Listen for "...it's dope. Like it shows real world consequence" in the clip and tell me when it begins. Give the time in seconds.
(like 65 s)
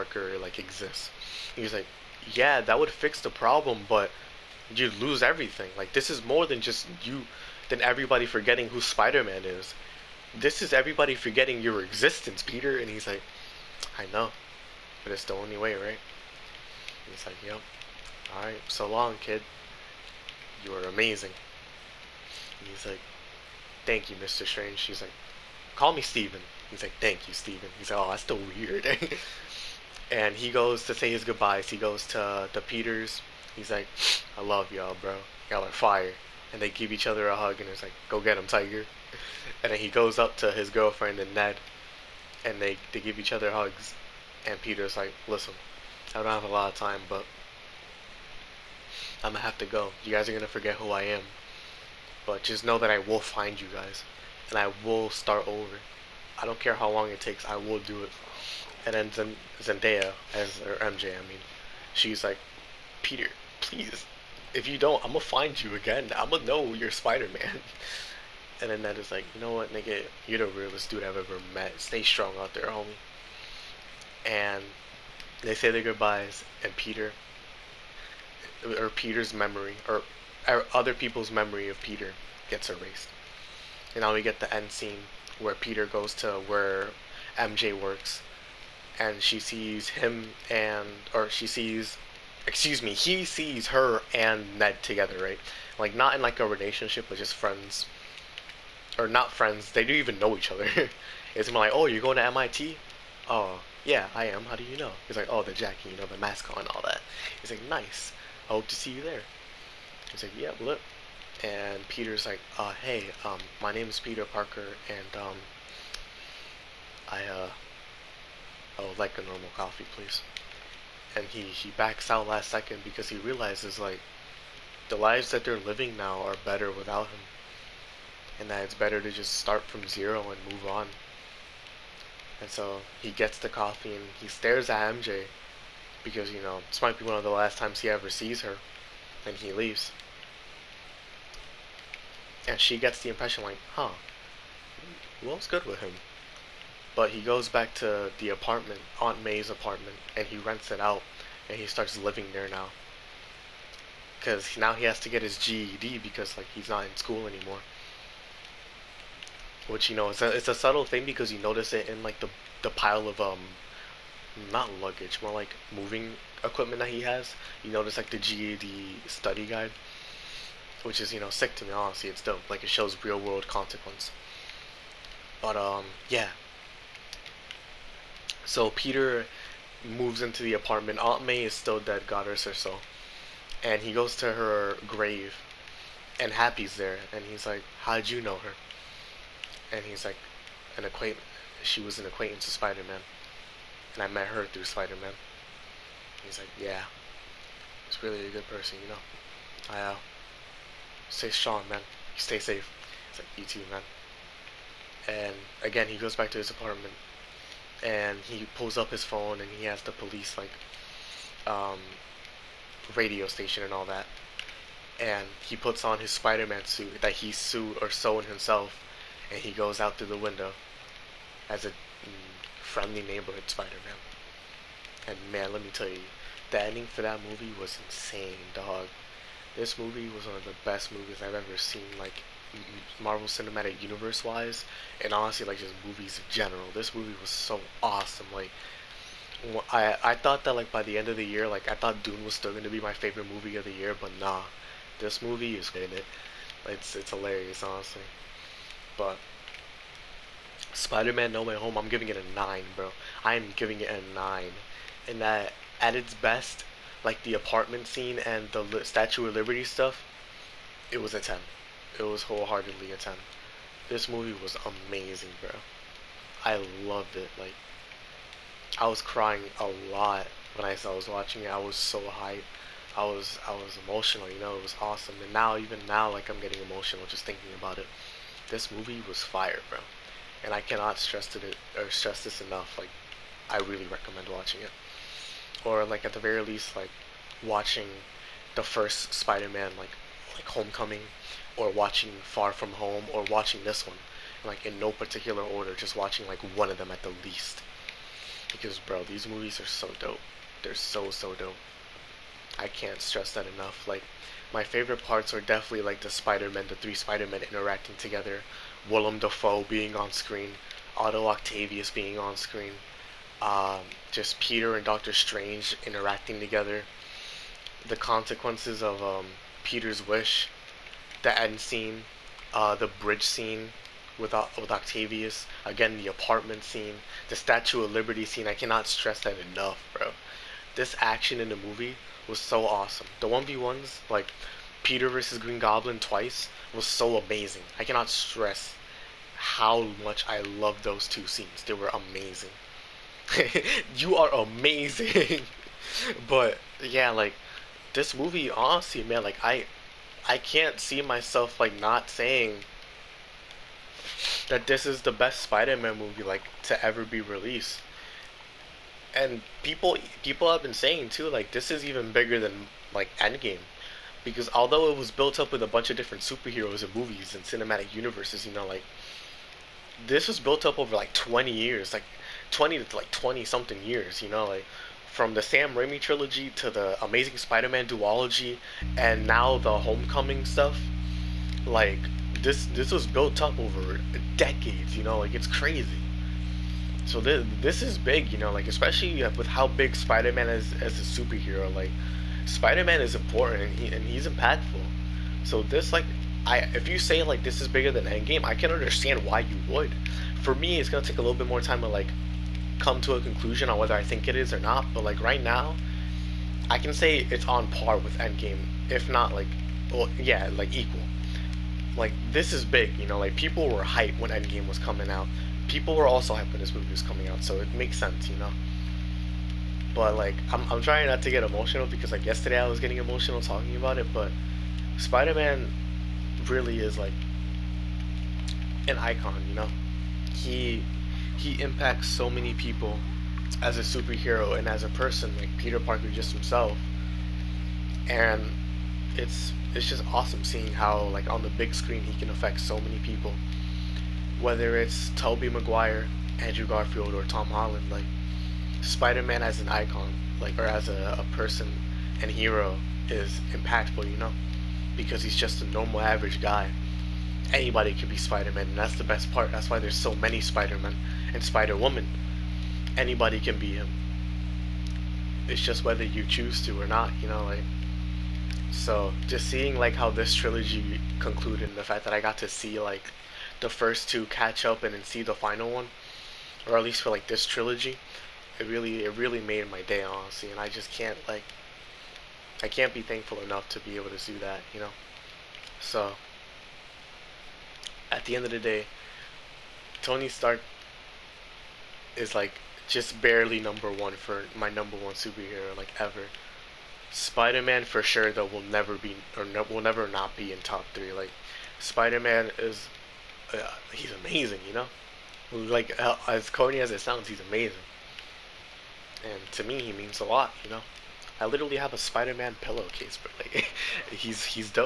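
172 s.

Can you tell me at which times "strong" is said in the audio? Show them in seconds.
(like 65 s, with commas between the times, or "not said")
72 s, 201 s.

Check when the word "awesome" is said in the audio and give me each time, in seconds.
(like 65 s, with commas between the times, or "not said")
237 s, 274 s, 332 s, 440 s.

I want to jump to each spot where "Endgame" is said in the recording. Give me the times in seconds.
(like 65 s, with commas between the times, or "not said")
363 s, 398 s, 408 s, 414 s.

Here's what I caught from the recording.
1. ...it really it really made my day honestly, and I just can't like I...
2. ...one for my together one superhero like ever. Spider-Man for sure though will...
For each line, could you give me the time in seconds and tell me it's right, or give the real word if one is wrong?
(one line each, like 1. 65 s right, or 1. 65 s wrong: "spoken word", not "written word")
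1. 478 s right
2. 493 s wrong: "number", not "together".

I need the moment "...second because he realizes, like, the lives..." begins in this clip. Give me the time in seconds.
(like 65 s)
122 s.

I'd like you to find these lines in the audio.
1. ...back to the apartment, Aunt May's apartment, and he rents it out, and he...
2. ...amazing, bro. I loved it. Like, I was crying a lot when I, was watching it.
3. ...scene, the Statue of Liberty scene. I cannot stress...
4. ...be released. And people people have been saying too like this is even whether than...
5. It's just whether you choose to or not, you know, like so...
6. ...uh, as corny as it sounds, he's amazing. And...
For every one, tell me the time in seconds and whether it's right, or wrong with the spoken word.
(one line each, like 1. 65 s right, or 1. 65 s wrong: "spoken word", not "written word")
1. 147 s right
2. 264 s right
3. 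326 s right
4. 357 s wrong: "bigger", not "whether"
5. 465 s right
6. 506 s right.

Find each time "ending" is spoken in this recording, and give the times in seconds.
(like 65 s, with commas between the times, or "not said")
226 s.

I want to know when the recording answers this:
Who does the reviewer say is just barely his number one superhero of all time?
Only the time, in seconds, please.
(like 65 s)
490 s.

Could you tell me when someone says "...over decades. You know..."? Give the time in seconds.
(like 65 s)
383 s.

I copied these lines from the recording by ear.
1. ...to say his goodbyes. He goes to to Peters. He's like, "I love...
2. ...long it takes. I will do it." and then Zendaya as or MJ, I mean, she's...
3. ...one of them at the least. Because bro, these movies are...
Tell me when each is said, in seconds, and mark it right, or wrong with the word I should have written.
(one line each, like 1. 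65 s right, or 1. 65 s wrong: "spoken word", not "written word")
1. 30 s right
2. 56 s right
3. 296 s right.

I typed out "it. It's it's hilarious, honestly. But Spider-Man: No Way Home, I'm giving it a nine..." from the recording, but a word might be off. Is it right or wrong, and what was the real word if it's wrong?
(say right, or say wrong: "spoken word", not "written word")
right.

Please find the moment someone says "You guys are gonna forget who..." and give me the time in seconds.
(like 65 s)
50 s.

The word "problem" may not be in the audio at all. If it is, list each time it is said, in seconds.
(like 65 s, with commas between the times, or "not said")
3 s.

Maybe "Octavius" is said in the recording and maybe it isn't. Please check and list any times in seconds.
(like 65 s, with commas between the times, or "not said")
311 s, 324 s.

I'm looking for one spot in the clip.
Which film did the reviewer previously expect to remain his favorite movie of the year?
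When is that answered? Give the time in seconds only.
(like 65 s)
242 s.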